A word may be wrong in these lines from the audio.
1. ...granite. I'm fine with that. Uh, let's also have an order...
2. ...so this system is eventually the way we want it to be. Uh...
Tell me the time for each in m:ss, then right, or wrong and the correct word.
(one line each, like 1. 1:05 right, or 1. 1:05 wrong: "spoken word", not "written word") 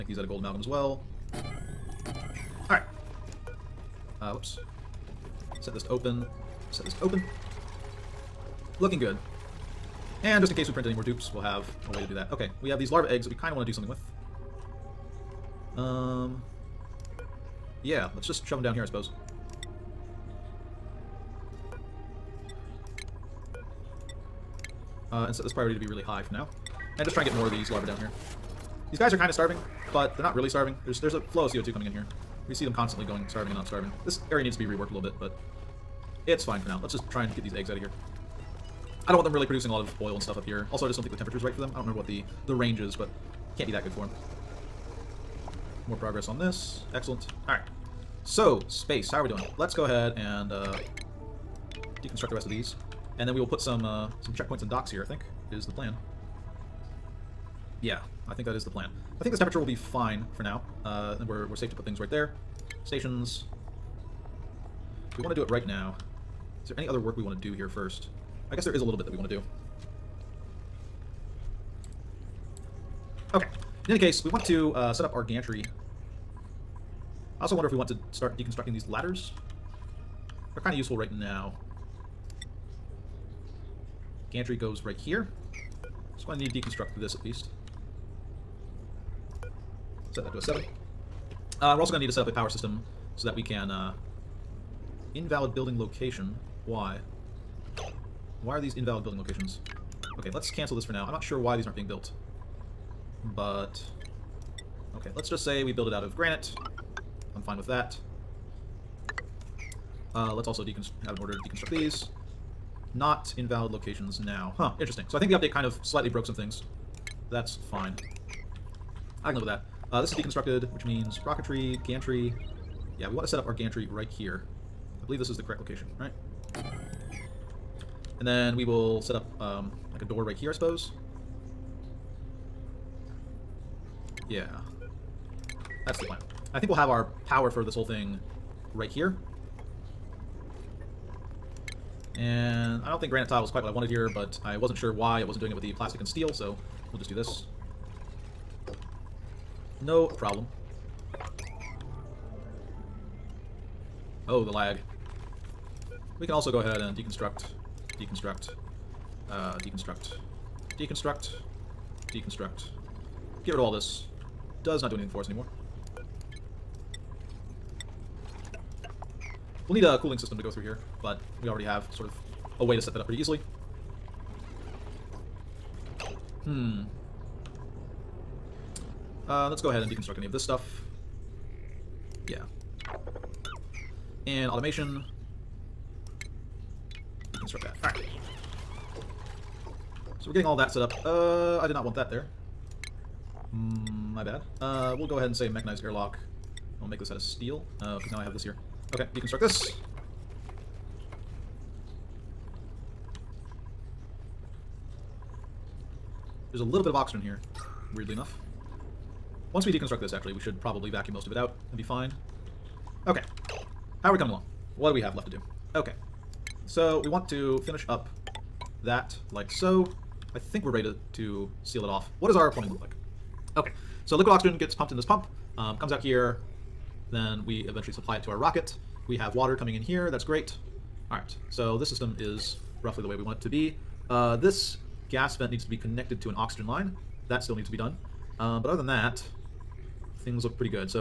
1. 1:46 right
2. 3:51 wrong: "roughly", not "eventually".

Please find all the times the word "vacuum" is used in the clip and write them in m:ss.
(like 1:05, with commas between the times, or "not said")
3:30.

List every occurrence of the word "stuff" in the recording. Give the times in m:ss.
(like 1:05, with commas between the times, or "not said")
0:40, 3:00.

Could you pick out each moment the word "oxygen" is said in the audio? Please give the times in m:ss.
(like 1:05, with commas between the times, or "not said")
3:26, 3:44, 3:56.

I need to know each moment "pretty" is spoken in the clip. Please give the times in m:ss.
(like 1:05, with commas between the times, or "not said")
2:53.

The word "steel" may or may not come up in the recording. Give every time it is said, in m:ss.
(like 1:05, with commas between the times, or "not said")
2:26, 3:17.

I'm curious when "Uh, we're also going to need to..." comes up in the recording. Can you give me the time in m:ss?
1:31.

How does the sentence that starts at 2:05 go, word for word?
I believe this is the correct location, right?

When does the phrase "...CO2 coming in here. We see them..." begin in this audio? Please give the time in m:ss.
0:31.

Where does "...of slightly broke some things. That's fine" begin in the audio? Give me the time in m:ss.
1:55.